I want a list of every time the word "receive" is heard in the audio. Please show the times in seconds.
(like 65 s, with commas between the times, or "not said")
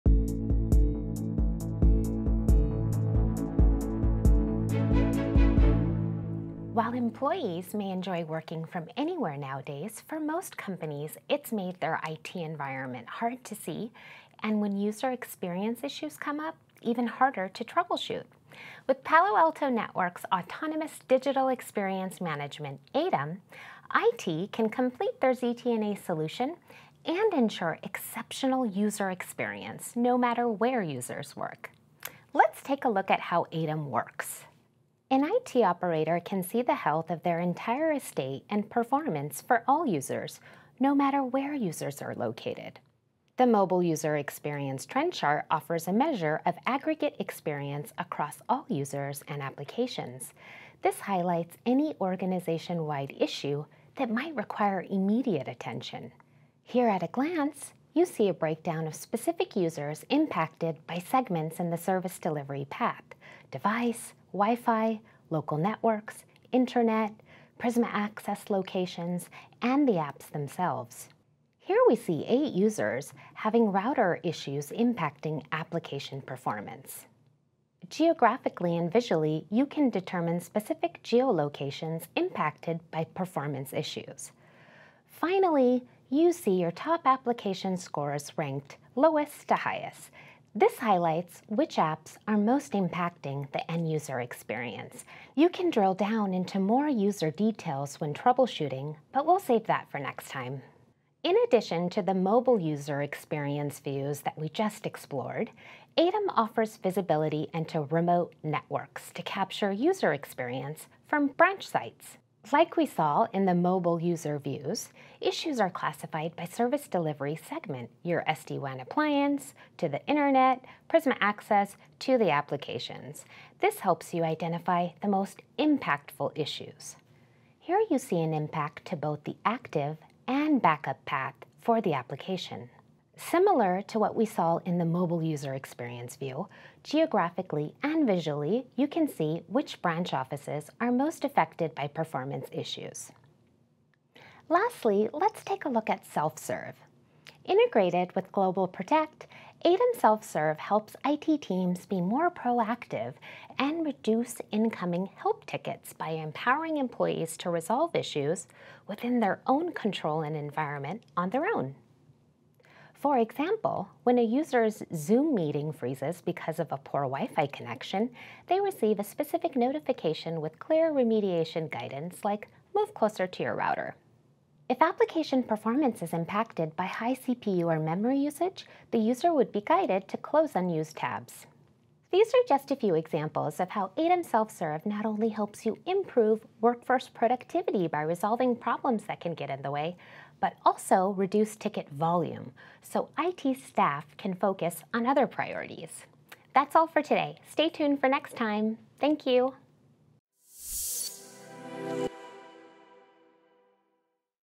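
168 s.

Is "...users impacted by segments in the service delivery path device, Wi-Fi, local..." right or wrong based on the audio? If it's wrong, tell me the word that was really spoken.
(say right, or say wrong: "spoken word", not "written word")
right.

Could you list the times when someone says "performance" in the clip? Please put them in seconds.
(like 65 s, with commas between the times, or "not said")
38 s, 76 s, 83 s, 141 s, 175 s.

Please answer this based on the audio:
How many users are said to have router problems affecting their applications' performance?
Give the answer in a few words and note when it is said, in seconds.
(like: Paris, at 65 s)
8, at 72 s.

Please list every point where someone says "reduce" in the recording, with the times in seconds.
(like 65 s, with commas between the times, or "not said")
153 s, 191 s.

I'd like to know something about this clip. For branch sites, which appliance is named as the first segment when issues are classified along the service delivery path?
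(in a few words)
SD-WAN appliance.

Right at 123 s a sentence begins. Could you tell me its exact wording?
This helps you identify the most impactful issues.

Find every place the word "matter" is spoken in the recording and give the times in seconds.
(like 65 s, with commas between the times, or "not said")
30 s, 40 s.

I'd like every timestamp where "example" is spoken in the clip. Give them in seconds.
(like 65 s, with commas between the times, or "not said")
163 s, 182 s.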